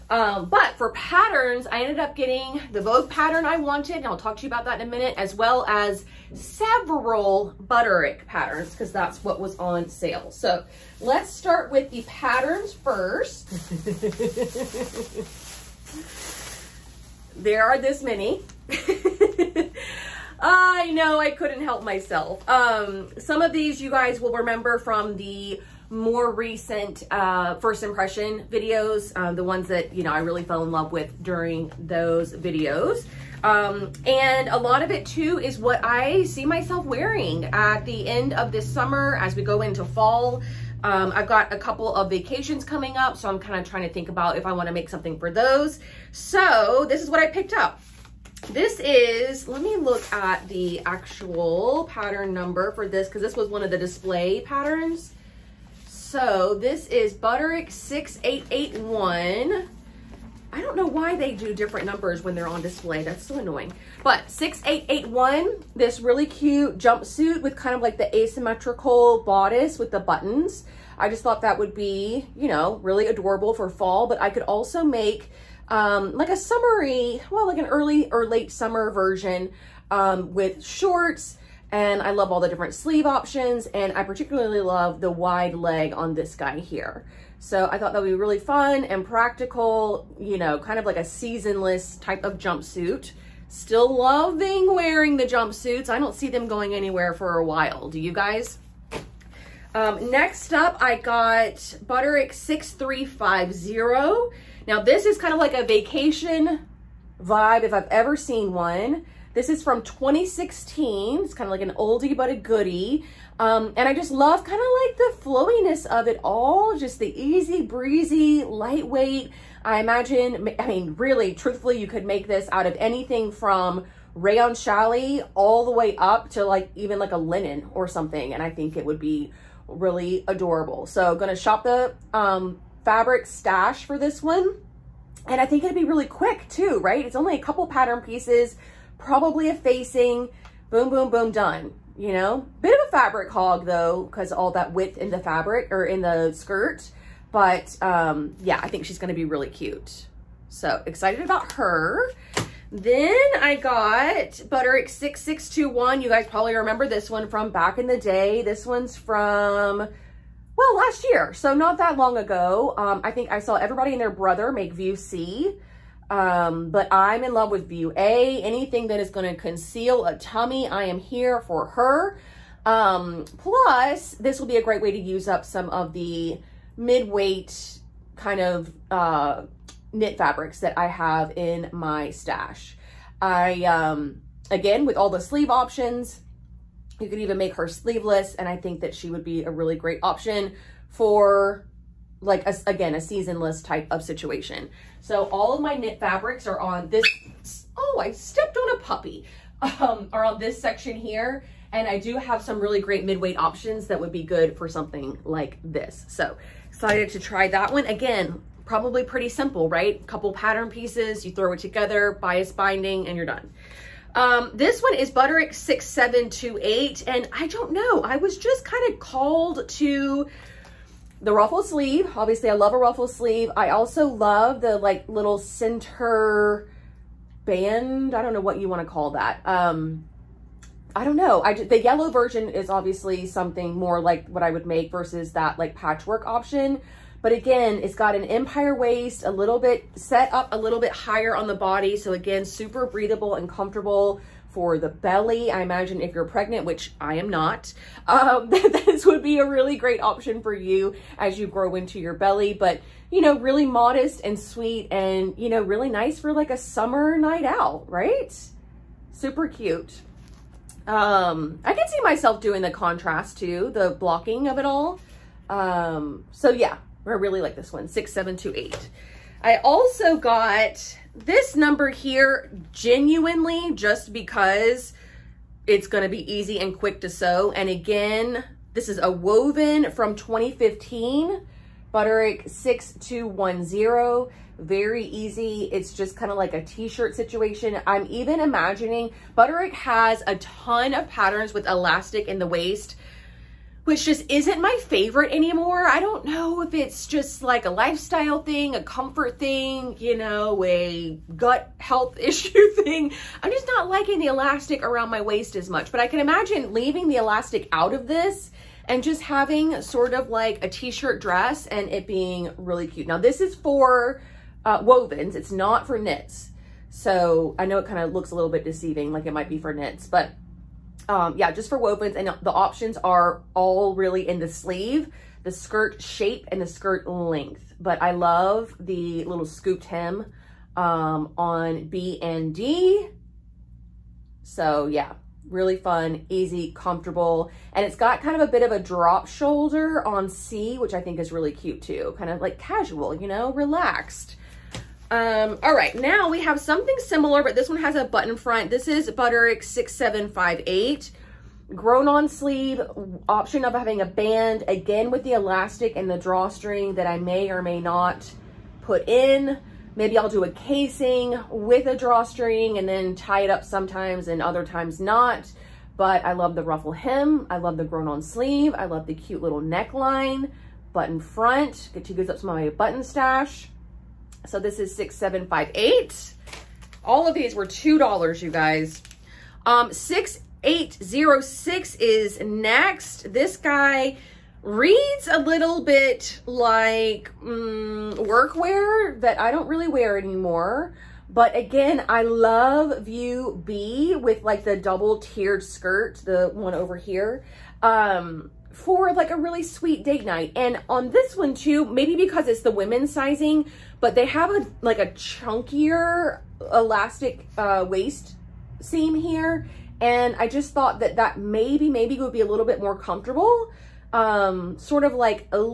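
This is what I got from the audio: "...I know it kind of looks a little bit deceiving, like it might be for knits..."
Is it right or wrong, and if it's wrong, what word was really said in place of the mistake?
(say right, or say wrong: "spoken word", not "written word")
right.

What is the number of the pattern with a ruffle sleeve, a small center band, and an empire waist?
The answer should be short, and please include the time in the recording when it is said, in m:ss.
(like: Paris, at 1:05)
Butterick 6728, at 3:35.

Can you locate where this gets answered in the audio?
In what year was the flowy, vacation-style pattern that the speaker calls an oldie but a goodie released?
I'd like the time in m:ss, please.
1:49.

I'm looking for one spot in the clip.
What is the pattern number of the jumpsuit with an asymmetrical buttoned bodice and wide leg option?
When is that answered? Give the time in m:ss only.
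0:57.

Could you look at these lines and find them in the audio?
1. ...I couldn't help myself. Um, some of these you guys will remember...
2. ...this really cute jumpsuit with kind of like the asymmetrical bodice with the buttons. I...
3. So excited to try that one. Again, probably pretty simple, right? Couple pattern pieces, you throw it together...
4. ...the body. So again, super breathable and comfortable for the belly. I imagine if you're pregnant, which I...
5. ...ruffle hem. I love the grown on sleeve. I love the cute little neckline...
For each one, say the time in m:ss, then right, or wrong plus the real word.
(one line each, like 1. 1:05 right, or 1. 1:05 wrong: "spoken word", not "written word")
1. 0:21 right
2. 1:05 right
3. 3:26 right
4. 4:01 right
5. 6:06 right.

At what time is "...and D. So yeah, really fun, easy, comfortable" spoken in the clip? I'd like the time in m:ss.
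5:32.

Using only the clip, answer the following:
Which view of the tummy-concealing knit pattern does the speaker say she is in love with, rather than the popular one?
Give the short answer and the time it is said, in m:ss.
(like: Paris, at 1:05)
View A, at 2:47.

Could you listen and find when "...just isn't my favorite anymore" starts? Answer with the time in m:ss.
4:54.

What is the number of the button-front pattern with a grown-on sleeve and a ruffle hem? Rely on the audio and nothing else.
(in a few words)
Butterick 6758.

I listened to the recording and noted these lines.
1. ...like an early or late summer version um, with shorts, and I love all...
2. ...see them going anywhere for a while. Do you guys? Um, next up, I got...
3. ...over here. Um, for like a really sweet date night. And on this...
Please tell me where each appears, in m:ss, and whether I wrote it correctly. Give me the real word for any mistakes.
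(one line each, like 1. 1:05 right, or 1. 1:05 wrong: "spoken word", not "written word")
1. 1:17 right
2. 1:36 right
3. 6:36 right.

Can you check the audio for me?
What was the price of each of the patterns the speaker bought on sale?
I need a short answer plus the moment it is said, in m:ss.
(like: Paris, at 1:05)
$2, at 6:17.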